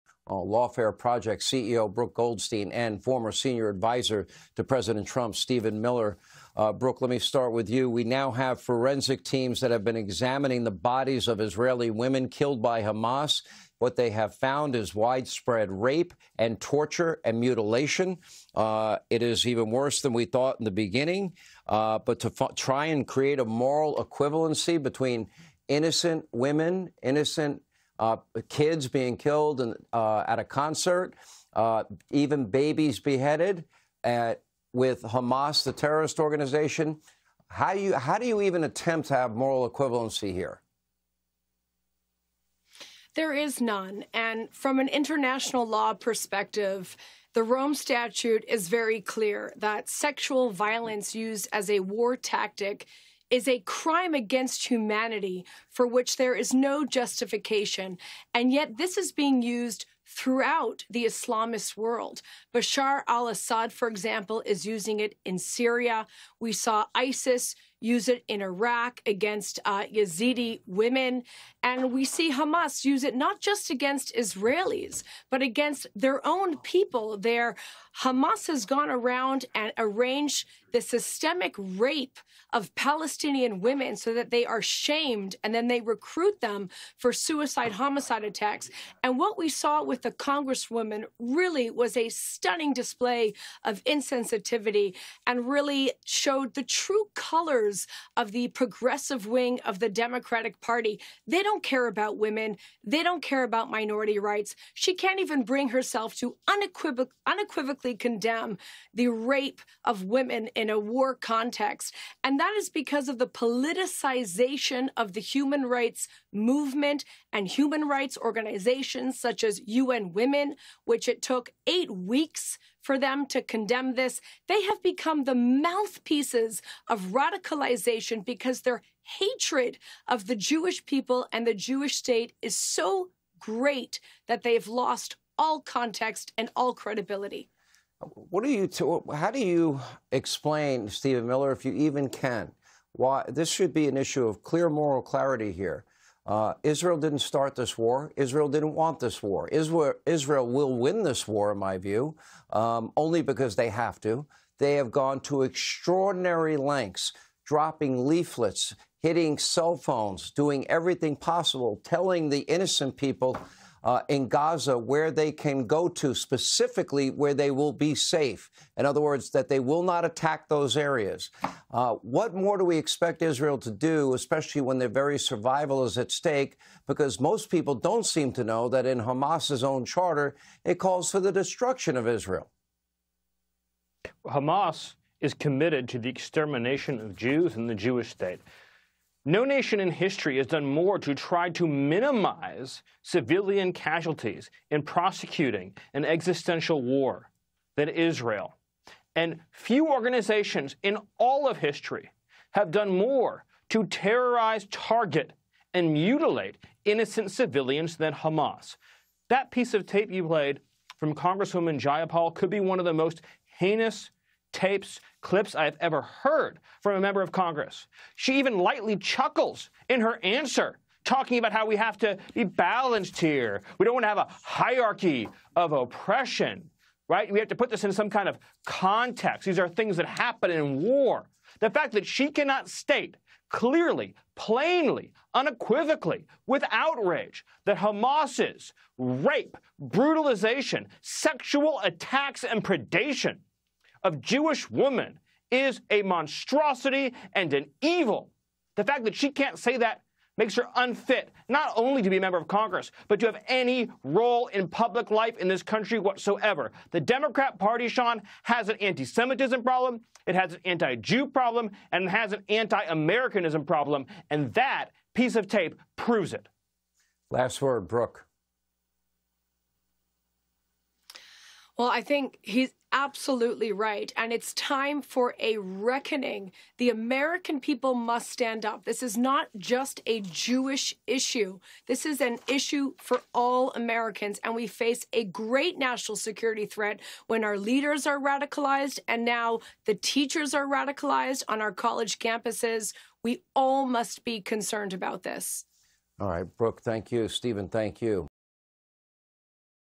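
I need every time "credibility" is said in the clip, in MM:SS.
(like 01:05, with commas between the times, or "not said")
02:16.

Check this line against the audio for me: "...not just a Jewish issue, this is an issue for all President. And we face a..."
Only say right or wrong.
wrong.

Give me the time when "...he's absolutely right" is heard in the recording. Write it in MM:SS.
04:32.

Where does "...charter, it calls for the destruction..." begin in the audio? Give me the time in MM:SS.
02:59.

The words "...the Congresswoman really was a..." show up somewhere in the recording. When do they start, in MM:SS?
01:30.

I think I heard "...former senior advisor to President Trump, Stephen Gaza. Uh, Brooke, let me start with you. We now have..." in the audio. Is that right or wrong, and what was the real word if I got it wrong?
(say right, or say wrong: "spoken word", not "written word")
wrong: "Miller", not "Gaza".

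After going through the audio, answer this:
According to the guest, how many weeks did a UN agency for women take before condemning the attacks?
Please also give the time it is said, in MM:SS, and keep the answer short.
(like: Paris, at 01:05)
8, at 02:01.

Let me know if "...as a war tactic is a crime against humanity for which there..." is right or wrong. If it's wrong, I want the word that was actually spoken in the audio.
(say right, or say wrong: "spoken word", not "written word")
right.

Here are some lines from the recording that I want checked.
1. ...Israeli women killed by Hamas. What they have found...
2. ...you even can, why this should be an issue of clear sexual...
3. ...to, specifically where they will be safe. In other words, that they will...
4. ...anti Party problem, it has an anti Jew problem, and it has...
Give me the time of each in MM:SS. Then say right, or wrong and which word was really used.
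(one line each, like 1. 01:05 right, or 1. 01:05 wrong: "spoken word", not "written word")
1. 00:11 right
2. 02:21 wrong: "moral", not "sexual"
3. 02:45 right
4. 04:18 wrong: "Semitism", not "Party".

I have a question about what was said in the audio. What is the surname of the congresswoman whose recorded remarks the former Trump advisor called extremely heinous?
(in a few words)
Jayapal.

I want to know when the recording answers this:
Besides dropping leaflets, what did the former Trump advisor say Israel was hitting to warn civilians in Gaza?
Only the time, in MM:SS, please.
02:39.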